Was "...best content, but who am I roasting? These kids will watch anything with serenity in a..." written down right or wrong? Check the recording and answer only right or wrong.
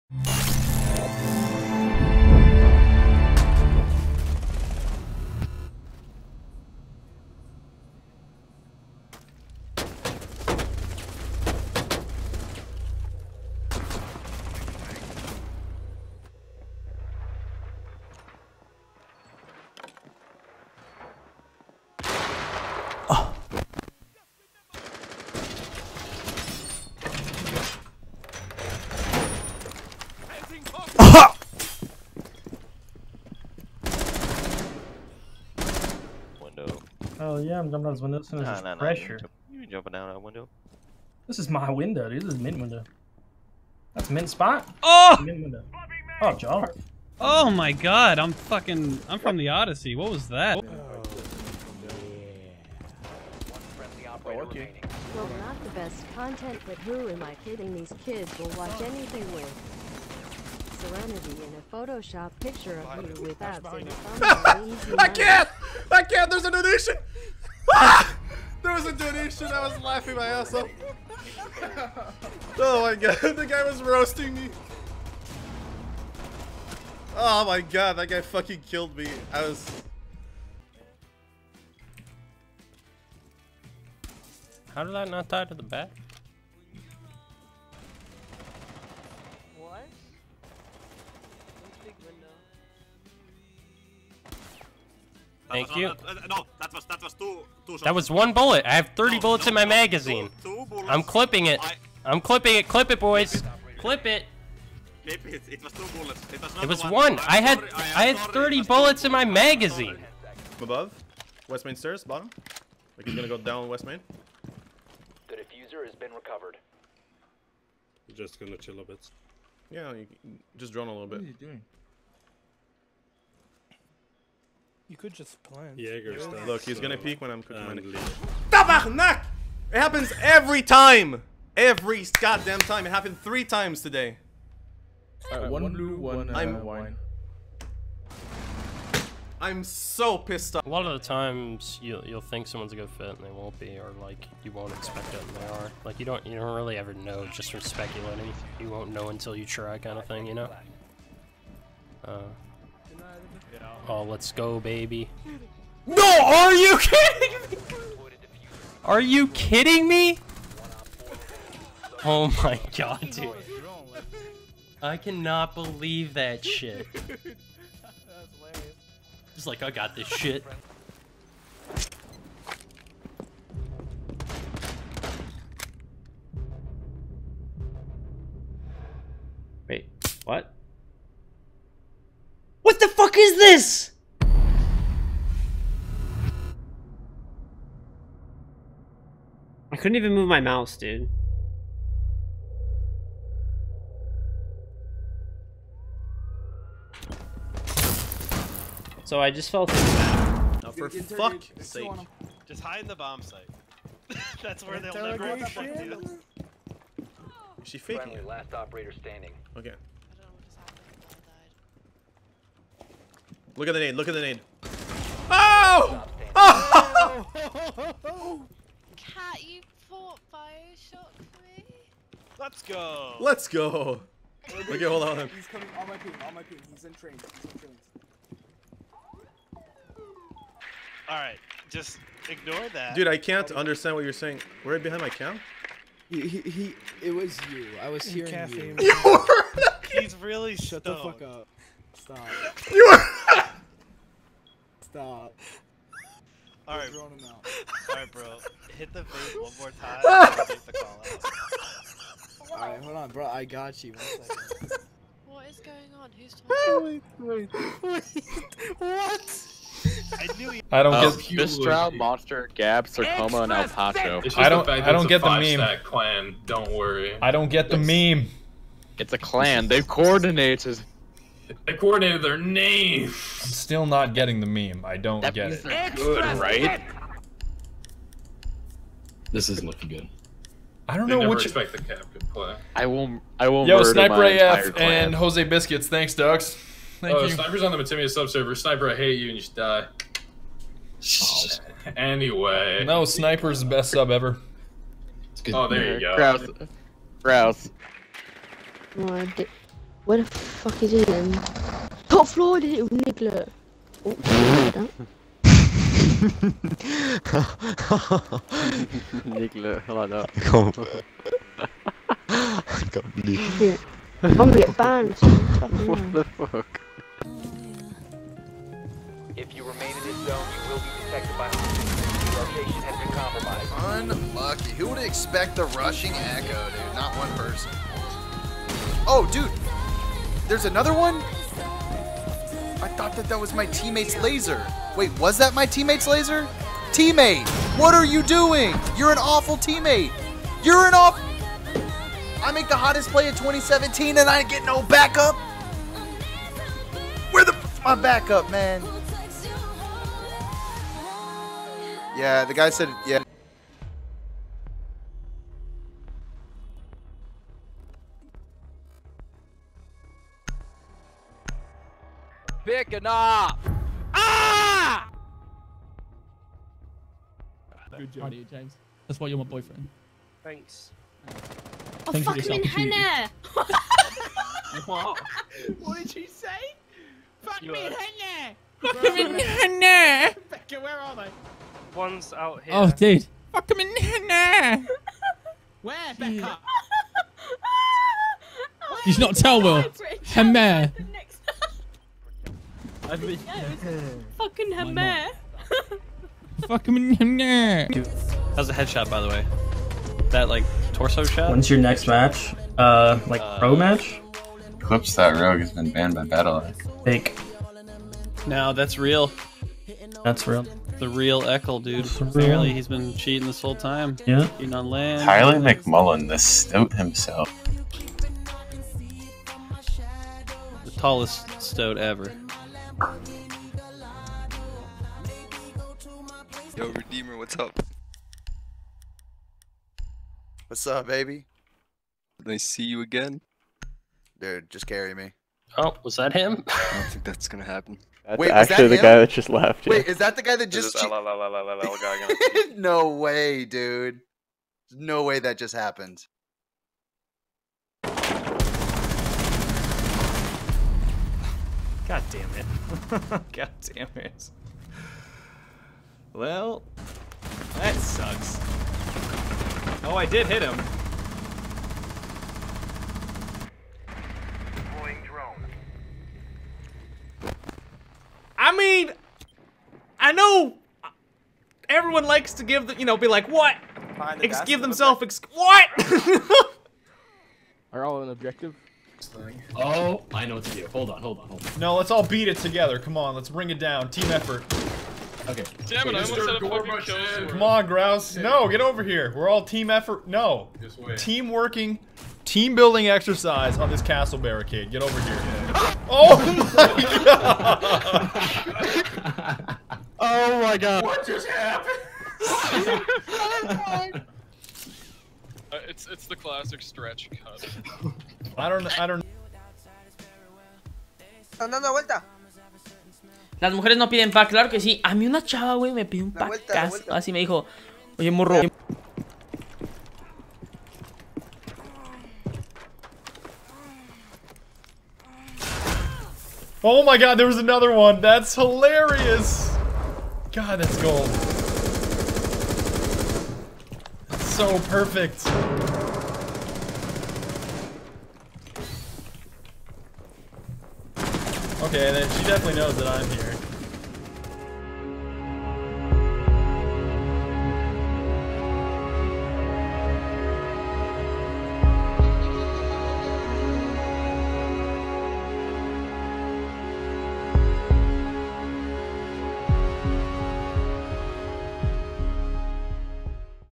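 wrong.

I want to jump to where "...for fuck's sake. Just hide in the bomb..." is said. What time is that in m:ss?
3:20.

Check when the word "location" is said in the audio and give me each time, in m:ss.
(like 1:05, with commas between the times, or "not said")
5:21.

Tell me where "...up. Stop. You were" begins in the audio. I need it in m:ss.
4:01.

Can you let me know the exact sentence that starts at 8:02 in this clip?
Come on, let's bring it down.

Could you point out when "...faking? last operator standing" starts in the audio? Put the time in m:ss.
3:27.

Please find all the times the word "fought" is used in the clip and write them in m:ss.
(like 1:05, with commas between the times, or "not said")
3:39.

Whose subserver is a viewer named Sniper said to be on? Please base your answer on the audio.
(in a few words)
Matimi0.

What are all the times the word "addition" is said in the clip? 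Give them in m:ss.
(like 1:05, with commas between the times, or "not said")
1:06.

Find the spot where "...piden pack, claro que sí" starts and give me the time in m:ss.
8:34.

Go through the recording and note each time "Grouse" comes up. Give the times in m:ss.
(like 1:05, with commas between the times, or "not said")
4:57, 8:07.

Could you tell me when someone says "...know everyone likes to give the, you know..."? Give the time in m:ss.
7:50.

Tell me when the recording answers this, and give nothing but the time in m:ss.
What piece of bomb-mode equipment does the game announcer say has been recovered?
1:55.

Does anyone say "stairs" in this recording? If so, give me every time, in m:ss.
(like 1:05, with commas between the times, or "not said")
1:51.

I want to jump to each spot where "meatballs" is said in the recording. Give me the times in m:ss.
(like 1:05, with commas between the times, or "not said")
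not said.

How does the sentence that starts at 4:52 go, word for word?
No, Sniper's the best sub ever.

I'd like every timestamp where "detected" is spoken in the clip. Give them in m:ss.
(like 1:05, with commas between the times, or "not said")
5:21.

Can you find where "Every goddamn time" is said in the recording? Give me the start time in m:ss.
2:11.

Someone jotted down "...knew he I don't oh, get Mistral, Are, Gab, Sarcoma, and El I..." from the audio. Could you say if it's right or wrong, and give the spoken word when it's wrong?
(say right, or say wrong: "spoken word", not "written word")
wrong: "Monster", not "Are".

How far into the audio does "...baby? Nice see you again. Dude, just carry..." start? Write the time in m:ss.
7:11.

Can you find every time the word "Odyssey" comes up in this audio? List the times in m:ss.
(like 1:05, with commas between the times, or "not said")
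0:49.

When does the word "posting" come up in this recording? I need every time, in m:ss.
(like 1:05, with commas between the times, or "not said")
not said.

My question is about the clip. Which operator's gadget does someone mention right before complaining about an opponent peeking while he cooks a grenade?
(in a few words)
Jaeger.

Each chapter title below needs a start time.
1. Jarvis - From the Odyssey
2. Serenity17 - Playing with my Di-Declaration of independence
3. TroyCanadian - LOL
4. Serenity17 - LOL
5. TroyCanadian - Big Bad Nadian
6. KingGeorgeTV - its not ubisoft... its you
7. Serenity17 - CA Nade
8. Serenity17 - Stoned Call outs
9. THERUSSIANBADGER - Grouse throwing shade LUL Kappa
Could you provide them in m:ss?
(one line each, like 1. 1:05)
1. 0:36
2. 0:50
3. 1:20
4. 1:50
5. 2:20
6. 2:50
7. 3:20
8. 3:50
9. 4:20.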